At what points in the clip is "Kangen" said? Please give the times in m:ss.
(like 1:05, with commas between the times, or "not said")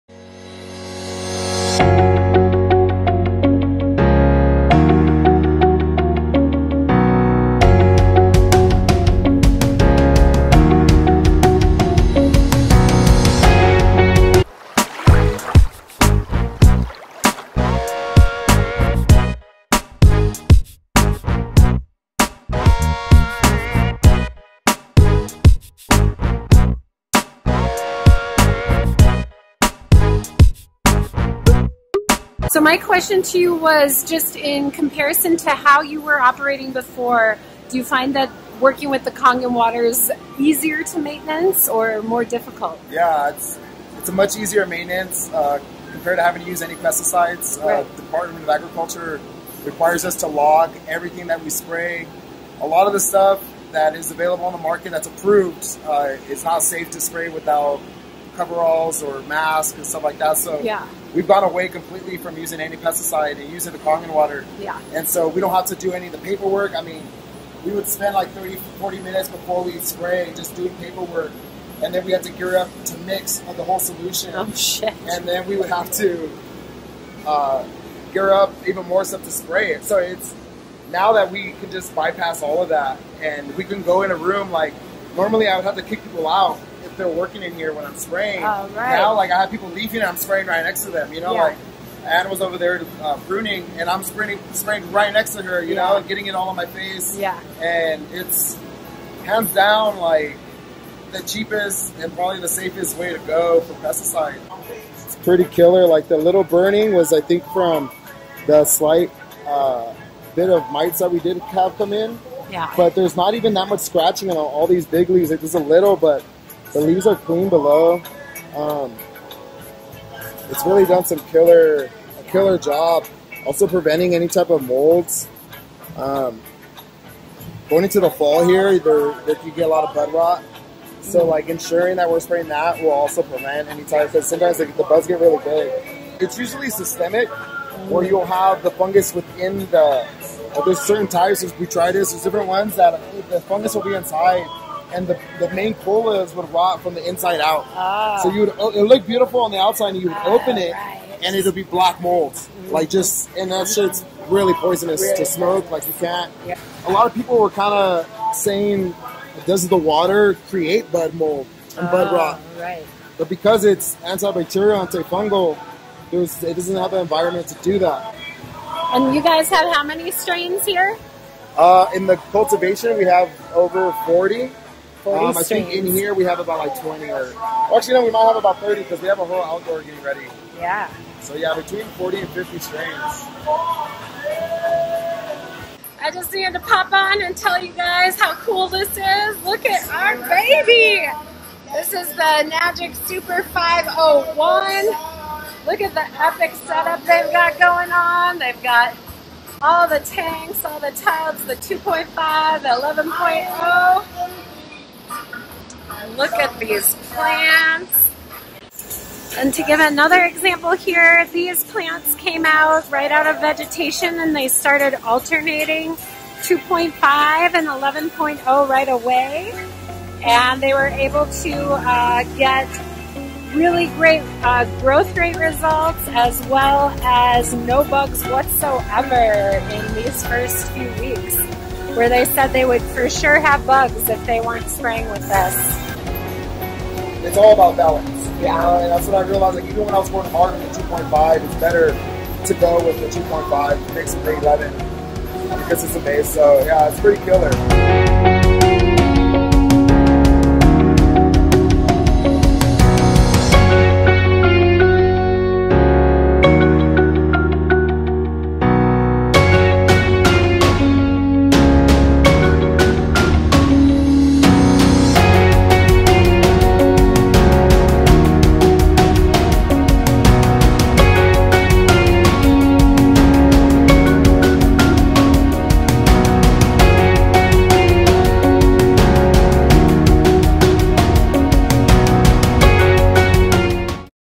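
0:39, 1:03.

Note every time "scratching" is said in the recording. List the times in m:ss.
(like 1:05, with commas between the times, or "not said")
1:53.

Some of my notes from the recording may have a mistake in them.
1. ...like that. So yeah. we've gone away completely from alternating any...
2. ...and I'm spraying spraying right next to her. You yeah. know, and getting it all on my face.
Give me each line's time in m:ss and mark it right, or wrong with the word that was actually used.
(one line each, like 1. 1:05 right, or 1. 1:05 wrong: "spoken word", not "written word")
1. 1:00 wrong: "using", not "alternating"
2. 1:33 right.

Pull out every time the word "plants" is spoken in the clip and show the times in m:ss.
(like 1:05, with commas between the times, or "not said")
3:27, 3:31.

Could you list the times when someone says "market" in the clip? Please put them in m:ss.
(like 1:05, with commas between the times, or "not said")
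0:54.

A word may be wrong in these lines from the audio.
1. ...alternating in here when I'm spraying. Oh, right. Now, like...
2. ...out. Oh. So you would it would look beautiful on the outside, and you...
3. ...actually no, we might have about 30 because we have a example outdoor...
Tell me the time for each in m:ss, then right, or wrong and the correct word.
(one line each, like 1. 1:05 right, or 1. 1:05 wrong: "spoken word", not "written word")
1. 1:27 wrong: "working", not "alternating"
2. 2:27 right
3. 2:57 wrong: "whole", not "example".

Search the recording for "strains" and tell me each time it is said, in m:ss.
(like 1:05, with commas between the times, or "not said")
2:50, 3:02.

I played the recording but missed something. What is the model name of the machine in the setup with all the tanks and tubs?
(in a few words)
Super 501.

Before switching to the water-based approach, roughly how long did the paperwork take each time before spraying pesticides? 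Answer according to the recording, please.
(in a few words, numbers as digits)
30-40 minutes.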